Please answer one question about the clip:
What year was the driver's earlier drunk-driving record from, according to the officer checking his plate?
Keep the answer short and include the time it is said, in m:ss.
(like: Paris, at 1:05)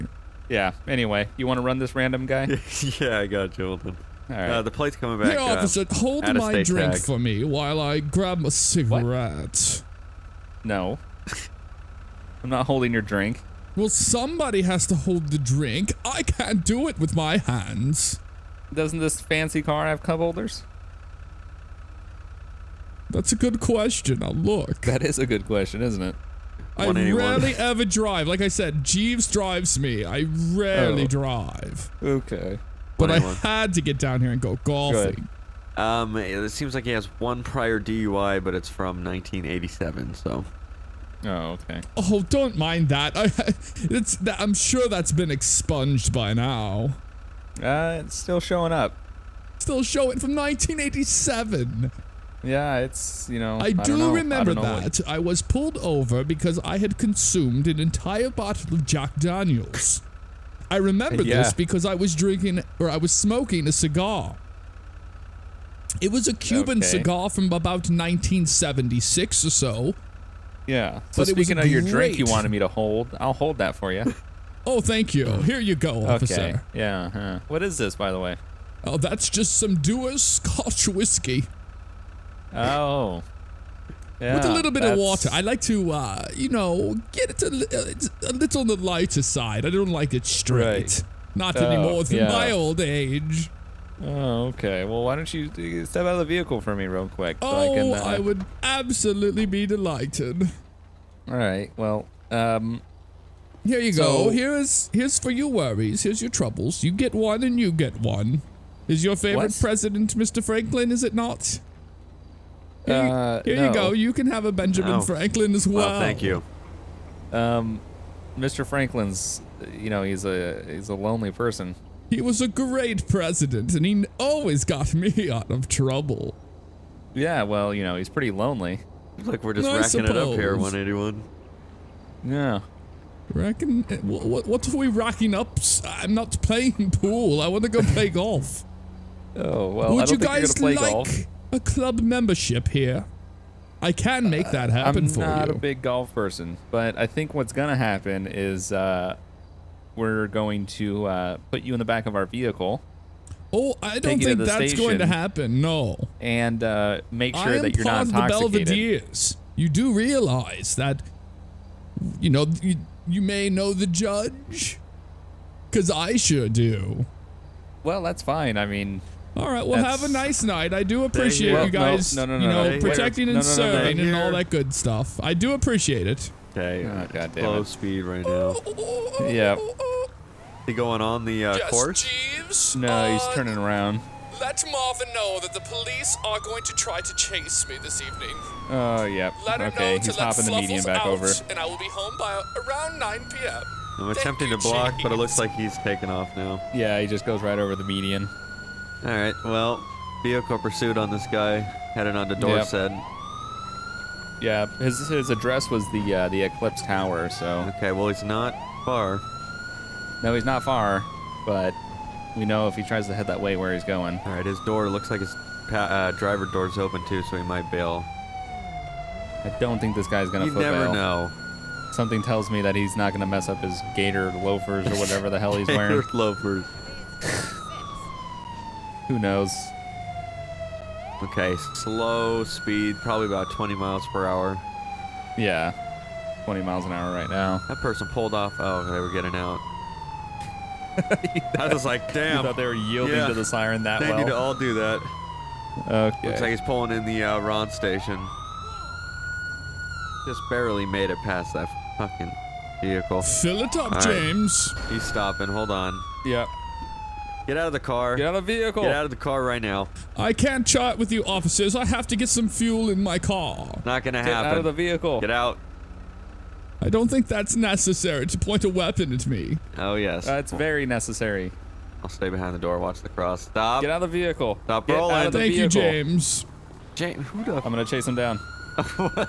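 1987, at 0:38.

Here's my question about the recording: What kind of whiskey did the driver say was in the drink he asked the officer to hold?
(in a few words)
Dewar's Scotch.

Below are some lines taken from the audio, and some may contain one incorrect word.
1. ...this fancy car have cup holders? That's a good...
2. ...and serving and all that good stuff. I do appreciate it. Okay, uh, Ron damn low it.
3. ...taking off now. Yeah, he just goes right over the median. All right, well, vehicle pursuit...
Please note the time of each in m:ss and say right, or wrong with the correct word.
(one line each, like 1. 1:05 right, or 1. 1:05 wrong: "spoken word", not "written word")
1. 0:18 right
2. 2:53 wrong: "God", not "Ron"
3. 3:15 right.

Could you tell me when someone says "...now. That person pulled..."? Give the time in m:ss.
3:57.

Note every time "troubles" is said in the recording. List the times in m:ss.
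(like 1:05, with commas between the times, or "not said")
1:46, 2:05.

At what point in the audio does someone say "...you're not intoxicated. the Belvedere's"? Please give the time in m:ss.
2:37.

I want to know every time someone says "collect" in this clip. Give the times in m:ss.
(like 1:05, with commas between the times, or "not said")
not said.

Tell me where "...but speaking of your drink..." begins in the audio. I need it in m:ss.
1:11.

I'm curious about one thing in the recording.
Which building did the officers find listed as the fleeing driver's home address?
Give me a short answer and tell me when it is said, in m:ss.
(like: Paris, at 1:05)
Eclipse Tower, at 3:26.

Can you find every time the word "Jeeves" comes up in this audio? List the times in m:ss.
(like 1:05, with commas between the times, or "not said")
0:28, 3:02.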